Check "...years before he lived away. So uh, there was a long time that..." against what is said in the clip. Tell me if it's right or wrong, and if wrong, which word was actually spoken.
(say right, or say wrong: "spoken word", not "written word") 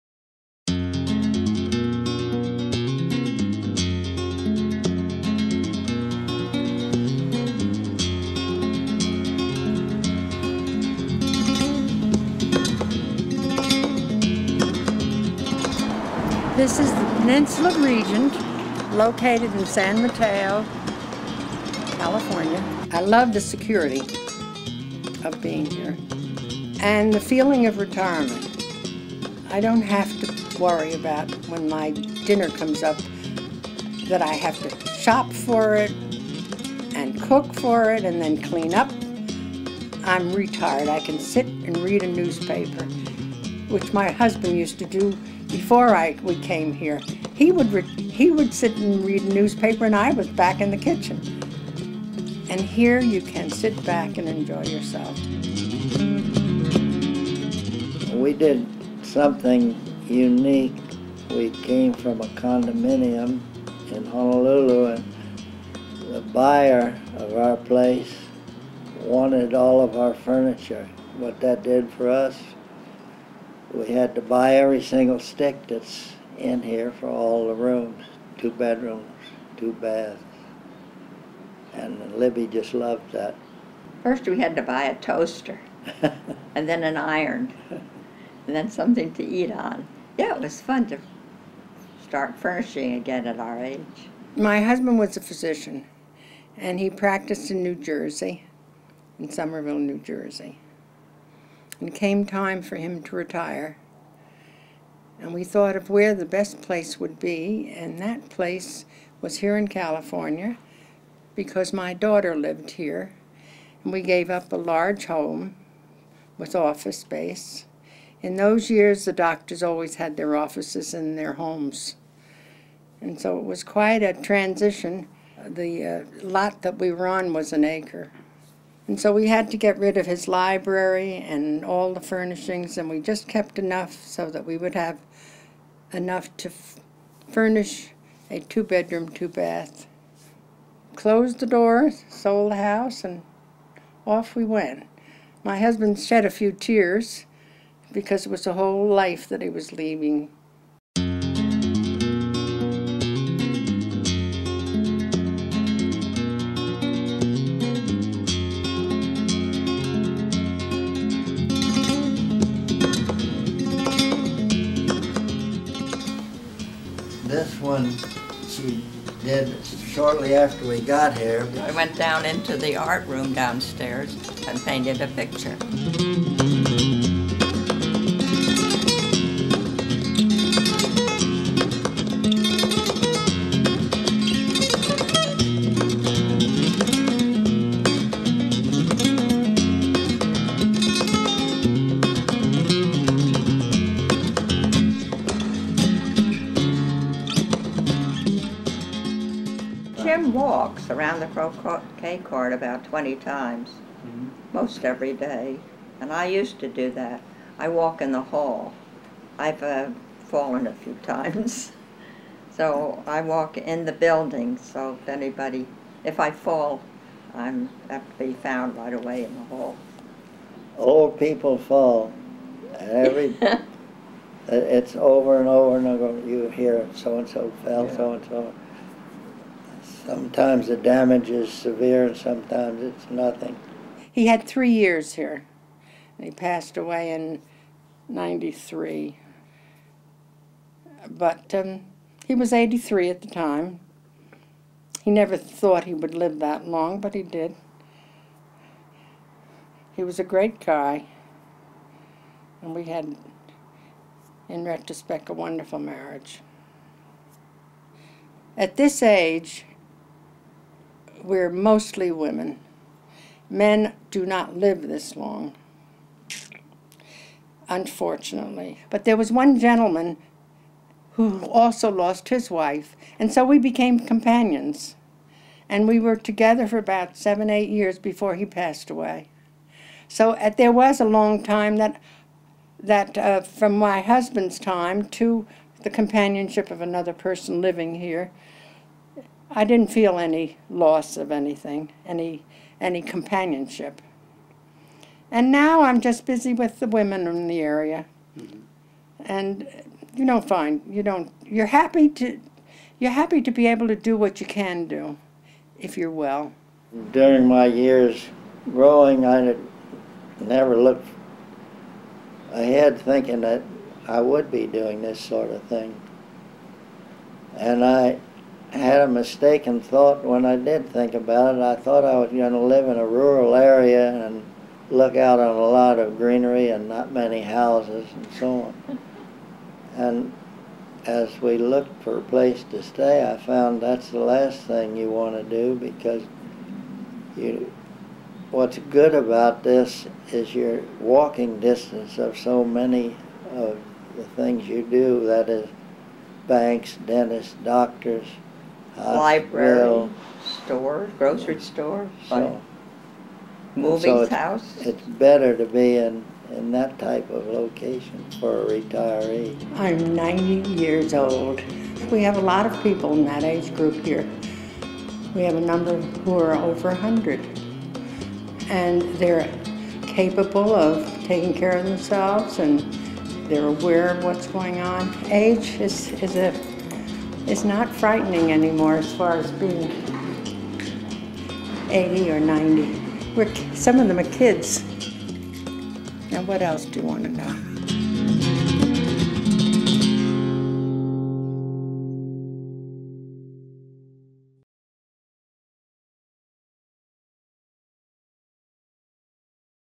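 wrong: "passed", not "lived".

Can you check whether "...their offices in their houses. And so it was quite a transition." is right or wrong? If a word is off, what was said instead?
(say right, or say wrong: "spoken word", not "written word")
wrong: "homes", not "houses".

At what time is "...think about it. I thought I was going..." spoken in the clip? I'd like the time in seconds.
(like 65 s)
320 s.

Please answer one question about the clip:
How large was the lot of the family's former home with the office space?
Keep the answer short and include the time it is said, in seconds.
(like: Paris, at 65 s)
an acre, at 127 s.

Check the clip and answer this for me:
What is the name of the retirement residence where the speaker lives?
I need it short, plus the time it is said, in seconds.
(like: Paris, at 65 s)
Peninsula Regent, at 17 s.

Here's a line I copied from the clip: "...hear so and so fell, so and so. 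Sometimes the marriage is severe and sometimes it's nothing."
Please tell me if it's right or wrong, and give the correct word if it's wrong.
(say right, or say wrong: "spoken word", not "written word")
wrong: "damage", not "marriage".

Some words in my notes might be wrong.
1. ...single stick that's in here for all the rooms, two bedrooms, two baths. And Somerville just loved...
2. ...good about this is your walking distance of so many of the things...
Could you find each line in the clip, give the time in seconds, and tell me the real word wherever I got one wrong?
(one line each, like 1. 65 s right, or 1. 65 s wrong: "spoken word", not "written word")
1. 74 s wrong: "Libby", not "Somerville"
2. 338 s right.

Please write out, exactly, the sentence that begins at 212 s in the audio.
So I walk in the building, so if anybody, if I fall, I'm have to be found right away in the hall.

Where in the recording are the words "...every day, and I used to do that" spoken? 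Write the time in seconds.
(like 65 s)
204 s.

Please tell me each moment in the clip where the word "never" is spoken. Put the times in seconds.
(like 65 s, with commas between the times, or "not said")
245 s, 310 s.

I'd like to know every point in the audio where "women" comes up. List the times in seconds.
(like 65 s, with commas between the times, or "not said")
262 s, 296 s.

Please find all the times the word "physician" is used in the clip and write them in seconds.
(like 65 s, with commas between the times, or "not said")
95 s.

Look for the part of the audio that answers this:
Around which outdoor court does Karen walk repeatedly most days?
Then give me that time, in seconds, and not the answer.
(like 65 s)
201 s.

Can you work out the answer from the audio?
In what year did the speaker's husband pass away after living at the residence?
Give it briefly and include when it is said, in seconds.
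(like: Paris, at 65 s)
1993, at 238 s.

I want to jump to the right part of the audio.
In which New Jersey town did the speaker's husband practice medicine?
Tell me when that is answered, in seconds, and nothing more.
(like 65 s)
99 s.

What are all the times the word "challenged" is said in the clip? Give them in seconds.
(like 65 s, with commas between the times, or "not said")
not said.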